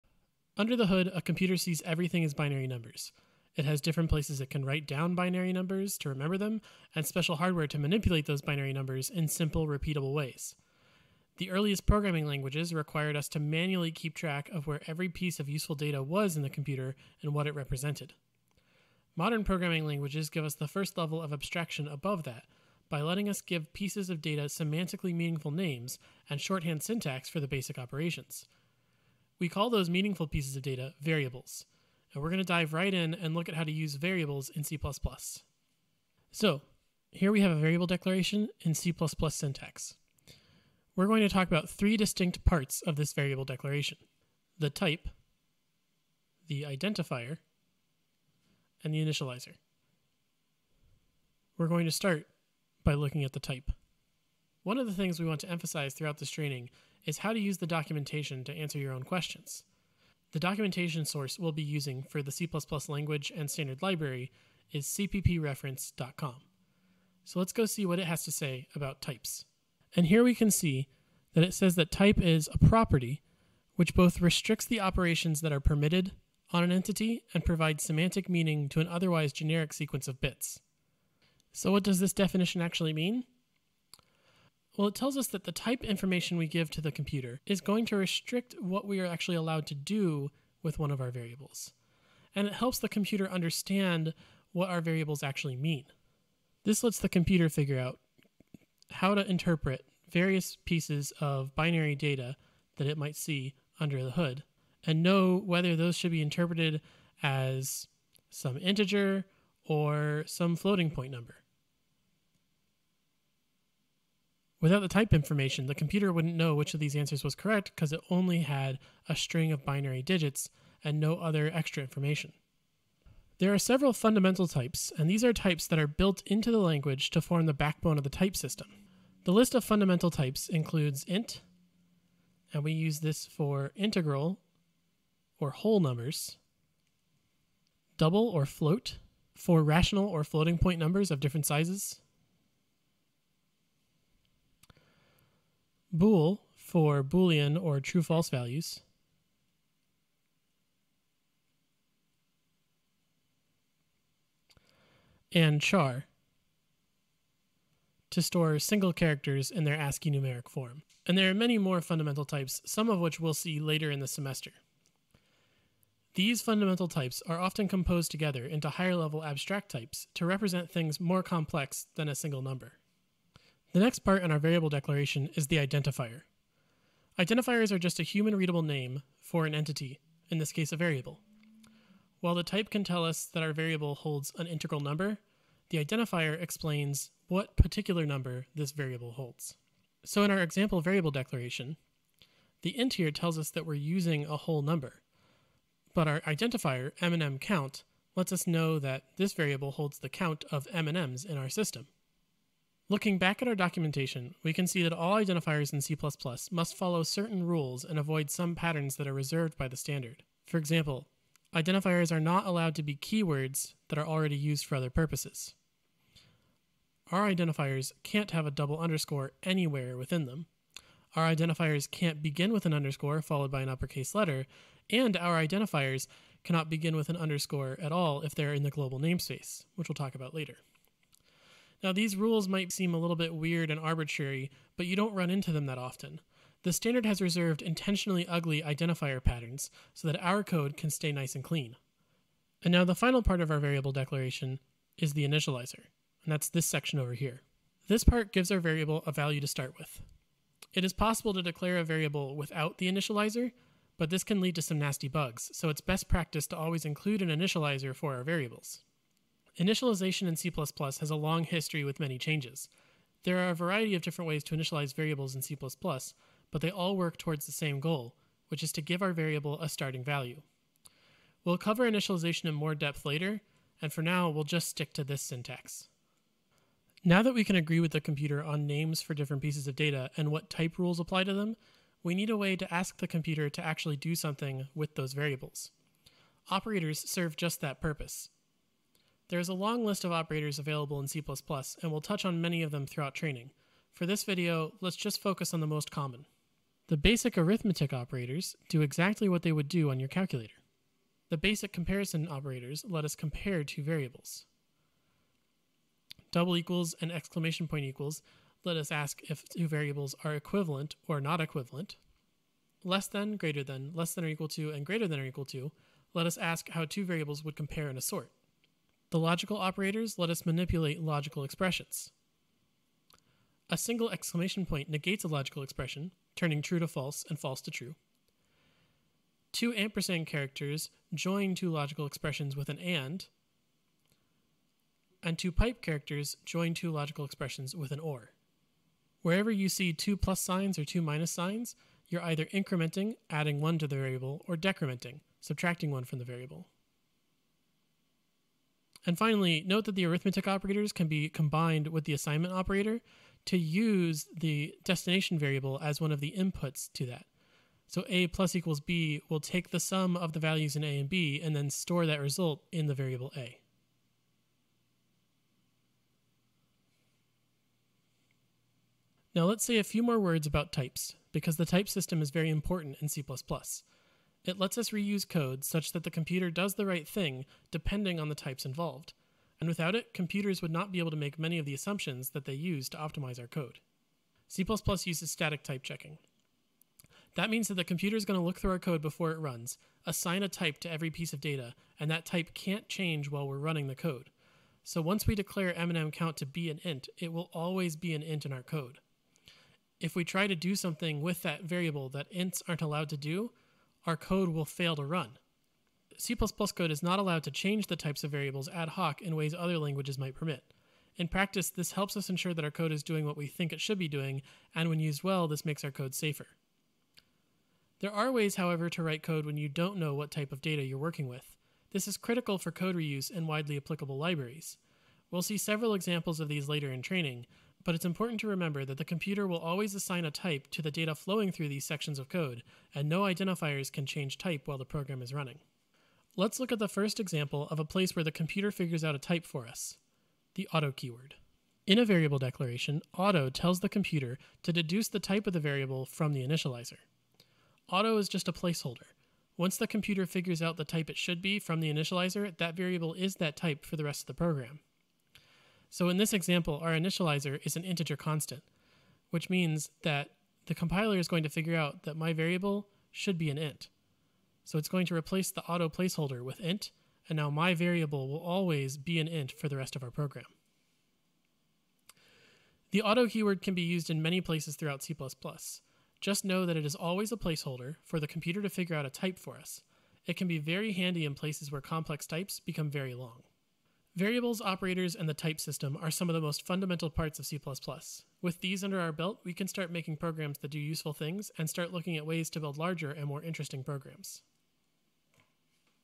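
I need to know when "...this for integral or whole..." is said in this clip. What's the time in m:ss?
2:12.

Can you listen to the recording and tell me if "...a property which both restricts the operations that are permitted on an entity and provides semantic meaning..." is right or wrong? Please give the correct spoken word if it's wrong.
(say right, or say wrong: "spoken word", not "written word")
right.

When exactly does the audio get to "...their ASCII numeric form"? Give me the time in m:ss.
2:39.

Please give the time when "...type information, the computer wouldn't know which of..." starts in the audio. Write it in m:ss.
1:54.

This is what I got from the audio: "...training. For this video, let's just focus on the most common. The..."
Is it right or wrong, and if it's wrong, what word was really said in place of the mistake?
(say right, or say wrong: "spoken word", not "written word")
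right.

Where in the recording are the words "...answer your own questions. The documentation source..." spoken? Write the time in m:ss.
0:58.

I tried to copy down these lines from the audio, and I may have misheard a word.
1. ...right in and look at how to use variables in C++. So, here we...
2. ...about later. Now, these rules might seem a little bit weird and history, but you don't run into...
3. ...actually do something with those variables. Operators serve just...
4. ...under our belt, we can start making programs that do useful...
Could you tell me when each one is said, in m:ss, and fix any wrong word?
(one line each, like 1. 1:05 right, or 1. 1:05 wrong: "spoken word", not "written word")
1. 0:32 right
2. 3:50 wrong: "arbitrary", not "history"
3. 4:43 right
4. 8:08 right.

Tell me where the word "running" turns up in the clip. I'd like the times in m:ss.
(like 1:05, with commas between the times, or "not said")
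6:33, 7:15.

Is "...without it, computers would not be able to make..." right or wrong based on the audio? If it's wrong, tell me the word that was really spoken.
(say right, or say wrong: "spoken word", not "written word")
right.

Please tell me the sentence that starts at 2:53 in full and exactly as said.
The next part in our variable declaration is the identifier.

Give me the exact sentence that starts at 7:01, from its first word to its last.
This is critical for code reuse and widely applicable libraries.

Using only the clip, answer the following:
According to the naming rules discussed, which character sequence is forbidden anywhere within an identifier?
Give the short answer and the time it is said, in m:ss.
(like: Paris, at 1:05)
double underscore, at 3:38.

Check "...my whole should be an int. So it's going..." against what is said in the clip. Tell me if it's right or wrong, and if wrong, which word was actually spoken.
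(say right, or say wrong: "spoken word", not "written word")
wrong: "variable", not "whole".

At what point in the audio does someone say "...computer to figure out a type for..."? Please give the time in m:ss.
7:58.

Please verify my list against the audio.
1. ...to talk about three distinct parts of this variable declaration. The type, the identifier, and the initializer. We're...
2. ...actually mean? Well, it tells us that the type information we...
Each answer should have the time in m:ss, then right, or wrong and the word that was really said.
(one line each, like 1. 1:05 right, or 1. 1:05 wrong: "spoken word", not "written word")
1. 0:41 right
2. 1:22 right.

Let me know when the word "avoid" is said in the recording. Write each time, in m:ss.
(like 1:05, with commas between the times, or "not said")
3:27.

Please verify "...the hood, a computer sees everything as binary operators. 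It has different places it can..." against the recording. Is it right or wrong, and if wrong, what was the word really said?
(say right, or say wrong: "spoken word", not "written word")
wrong: "numbers", not "operators".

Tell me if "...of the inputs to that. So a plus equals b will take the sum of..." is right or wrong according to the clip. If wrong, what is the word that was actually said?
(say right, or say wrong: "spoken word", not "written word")
right.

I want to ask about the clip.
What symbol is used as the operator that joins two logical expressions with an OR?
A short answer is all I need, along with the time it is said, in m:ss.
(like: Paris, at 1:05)
two pipe characters, at 5:35.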